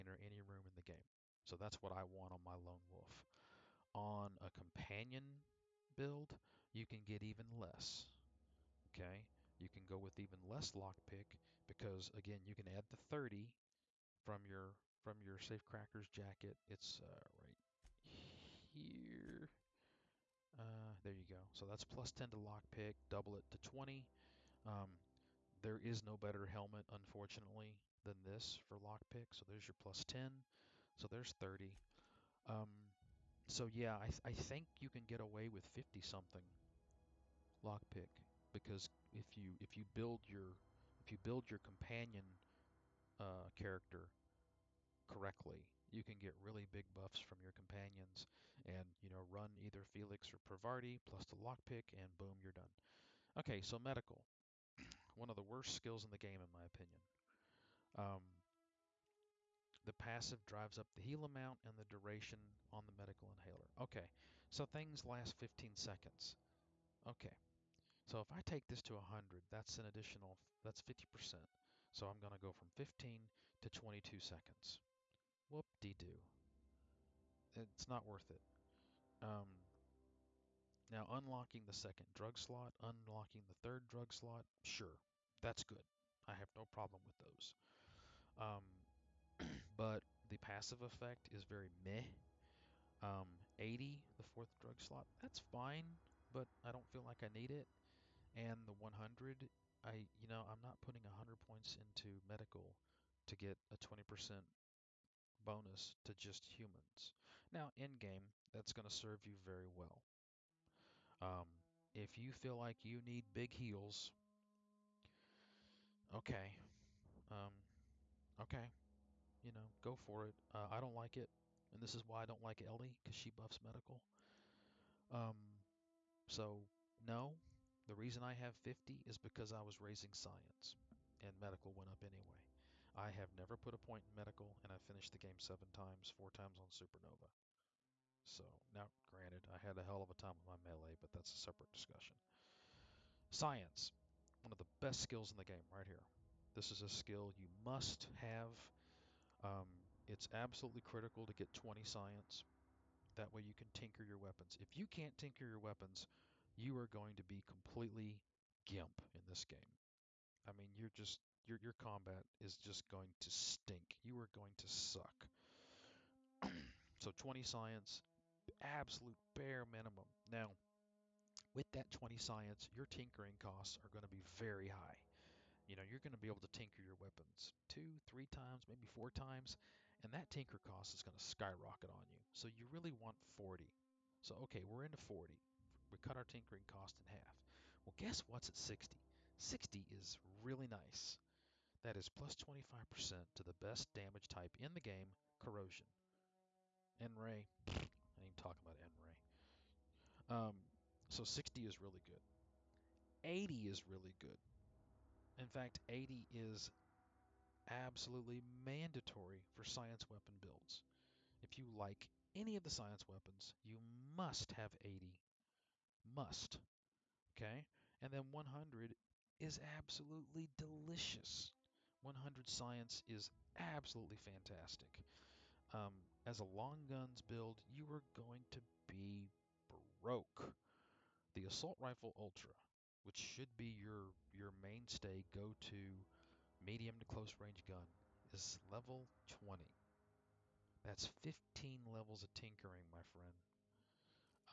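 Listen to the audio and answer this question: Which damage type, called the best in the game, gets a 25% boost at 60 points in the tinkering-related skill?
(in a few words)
Corrosion.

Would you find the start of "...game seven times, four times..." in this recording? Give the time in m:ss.
2:15.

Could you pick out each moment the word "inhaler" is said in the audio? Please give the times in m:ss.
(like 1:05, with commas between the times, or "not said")
1:03.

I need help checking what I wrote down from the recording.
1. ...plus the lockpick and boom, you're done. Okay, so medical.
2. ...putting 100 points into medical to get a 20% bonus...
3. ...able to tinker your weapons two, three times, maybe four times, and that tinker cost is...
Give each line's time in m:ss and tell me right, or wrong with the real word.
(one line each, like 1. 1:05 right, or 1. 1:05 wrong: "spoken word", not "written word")
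1. 0:51 right
2. 1:40 right
3. 2:56 right.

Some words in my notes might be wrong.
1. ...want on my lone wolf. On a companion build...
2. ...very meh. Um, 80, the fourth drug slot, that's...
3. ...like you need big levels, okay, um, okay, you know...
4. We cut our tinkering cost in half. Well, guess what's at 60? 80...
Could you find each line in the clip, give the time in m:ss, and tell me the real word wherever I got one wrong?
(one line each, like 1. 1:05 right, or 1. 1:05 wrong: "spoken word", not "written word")
1. 0:02 right
2. 1:31 right
3. 1:52 wrong: "heals", not "levels"
4. 3:05 wrong: "60", not "80".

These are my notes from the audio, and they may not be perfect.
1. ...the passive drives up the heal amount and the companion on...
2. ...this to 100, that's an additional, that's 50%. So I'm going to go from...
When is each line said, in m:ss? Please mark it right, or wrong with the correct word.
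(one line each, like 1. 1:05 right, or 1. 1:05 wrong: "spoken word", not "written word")
1. 0:59 wrong: "duration", not "companion"
2. 1:08 right.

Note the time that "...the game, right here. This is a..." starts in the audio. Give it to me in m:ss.
2:25.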